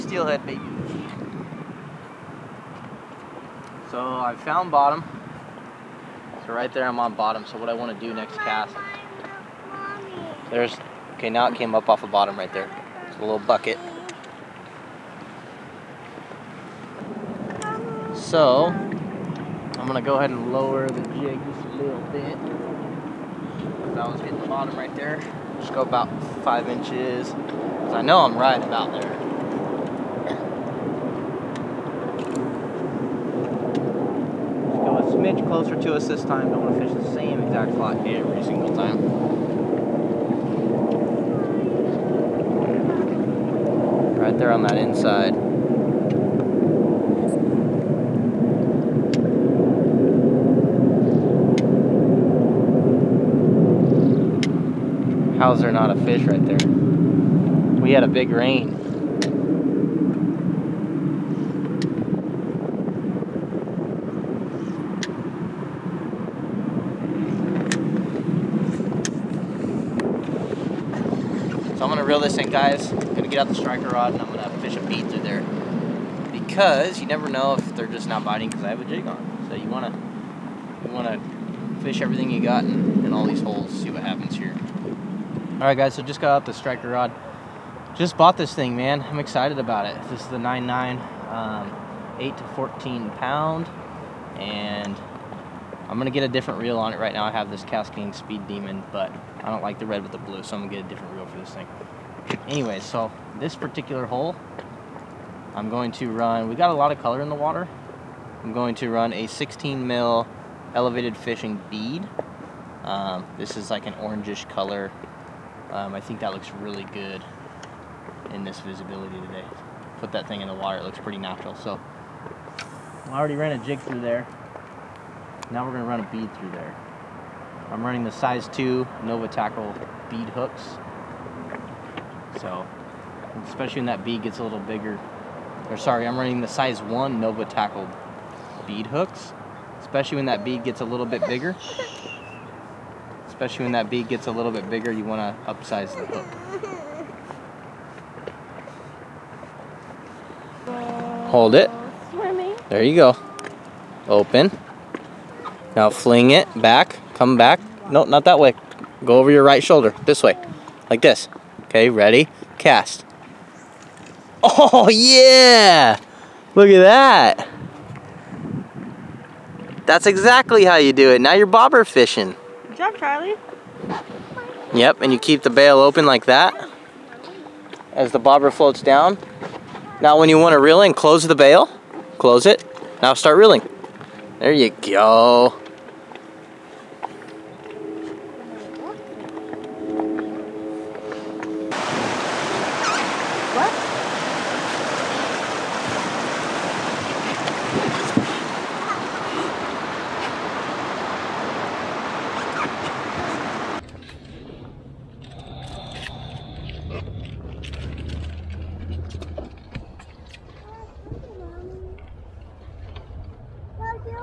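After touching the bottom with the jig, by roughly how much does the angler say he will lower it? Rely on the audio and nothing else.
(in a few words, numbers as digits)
5 inches.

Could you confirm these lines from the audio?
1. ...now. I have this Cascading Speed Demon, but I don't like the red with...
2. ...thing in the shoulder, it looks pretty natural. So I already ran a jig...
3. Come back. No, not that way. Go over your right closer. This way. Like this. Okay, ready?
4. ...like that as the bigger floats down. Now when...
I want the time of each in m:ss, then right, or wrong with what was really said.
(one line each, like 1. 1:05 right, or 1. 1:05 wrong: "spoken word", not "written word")
1. 1:37 right
2. 2:00 wrong: "water", not "shoulder"
3. 2:37 wrong: "shoulder", not "closer"
4. 2:56 wrong: "bobber", not "bigger".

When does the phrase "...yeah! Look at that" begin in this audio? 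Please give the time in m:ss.
2:44.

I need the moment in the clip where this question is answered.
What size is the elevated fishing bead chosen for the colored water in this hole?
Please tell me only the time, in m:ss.
1:49.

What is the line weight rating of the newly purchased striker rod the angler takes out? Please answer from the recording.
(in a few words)
8 to 14 pound.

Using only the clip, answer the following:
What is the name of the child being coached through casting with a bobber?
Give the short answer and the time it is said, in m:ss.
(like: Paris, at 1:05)
Charlie, at 2:52.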